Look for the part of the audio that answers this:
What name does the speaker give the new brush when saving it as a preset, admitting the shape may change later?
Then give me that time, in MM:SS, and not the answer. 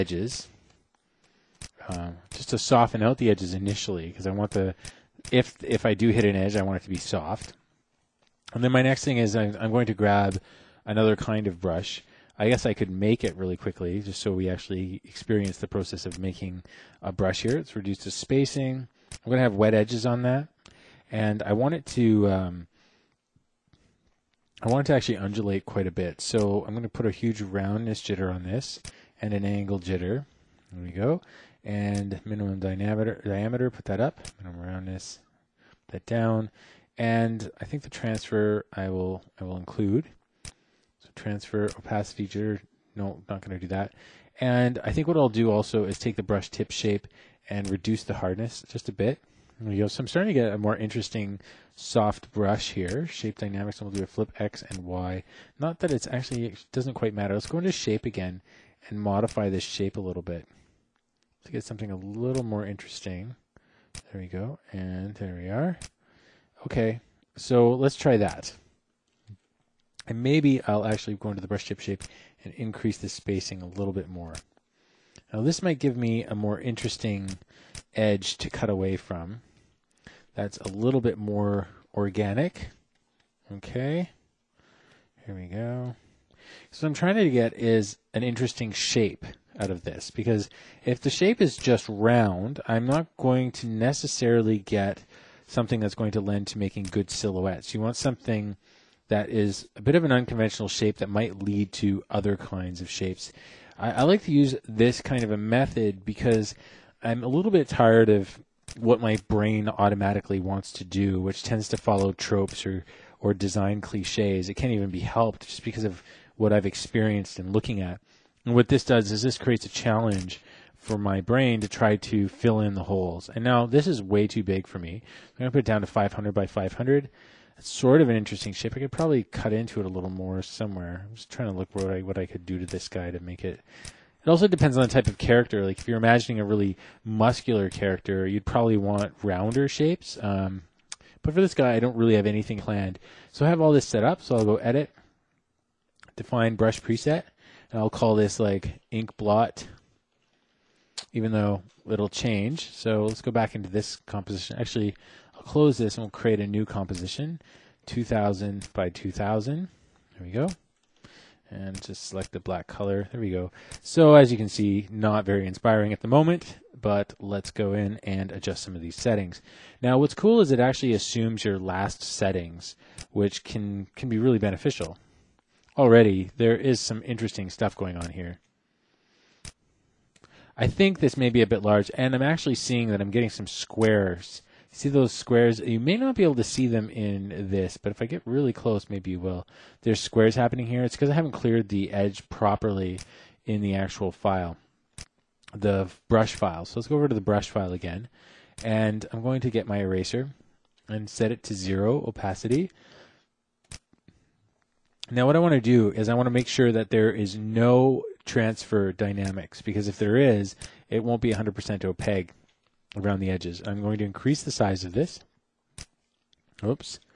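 02:28.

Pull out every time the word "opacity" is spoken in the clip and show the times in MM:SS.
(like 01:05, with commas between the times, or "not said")
00:41, 03:22.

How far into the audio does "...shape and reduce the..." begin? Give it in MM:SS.
00:46.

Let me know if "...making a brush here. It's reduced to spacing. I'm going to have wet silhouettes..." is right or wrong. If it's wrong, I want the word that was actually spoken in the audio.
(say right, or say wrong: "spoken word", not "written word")
wrong: "edges", not "silhouettes".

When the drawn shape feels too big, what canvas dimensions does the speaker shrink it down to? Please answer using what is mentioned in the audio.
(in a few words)
500 by 500.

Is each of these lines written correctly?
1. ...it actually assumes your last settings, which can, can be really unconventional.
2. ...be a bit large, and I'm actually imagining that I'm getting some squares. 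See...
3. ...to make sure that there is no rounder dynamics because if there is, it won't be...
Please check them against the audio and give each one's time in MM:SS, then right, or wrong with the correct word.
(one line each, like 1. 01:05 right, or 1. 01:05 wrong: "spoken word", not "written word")
1. 02:50 wrong: "beneficial", not "unconventional"
2. 03:01 wrong: "seeing", not "imagining"
3. 03:26 wrong: "transfer", not "rounder".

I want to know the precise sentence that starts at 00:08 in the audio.
And then my next thing is I'm, I'm going to grab another kind of brush.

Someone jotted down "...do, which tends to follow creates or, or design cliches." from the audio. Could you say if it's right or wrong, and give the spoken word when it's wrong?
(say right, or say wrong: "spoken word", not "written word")
wrong: "tropes", not "creates".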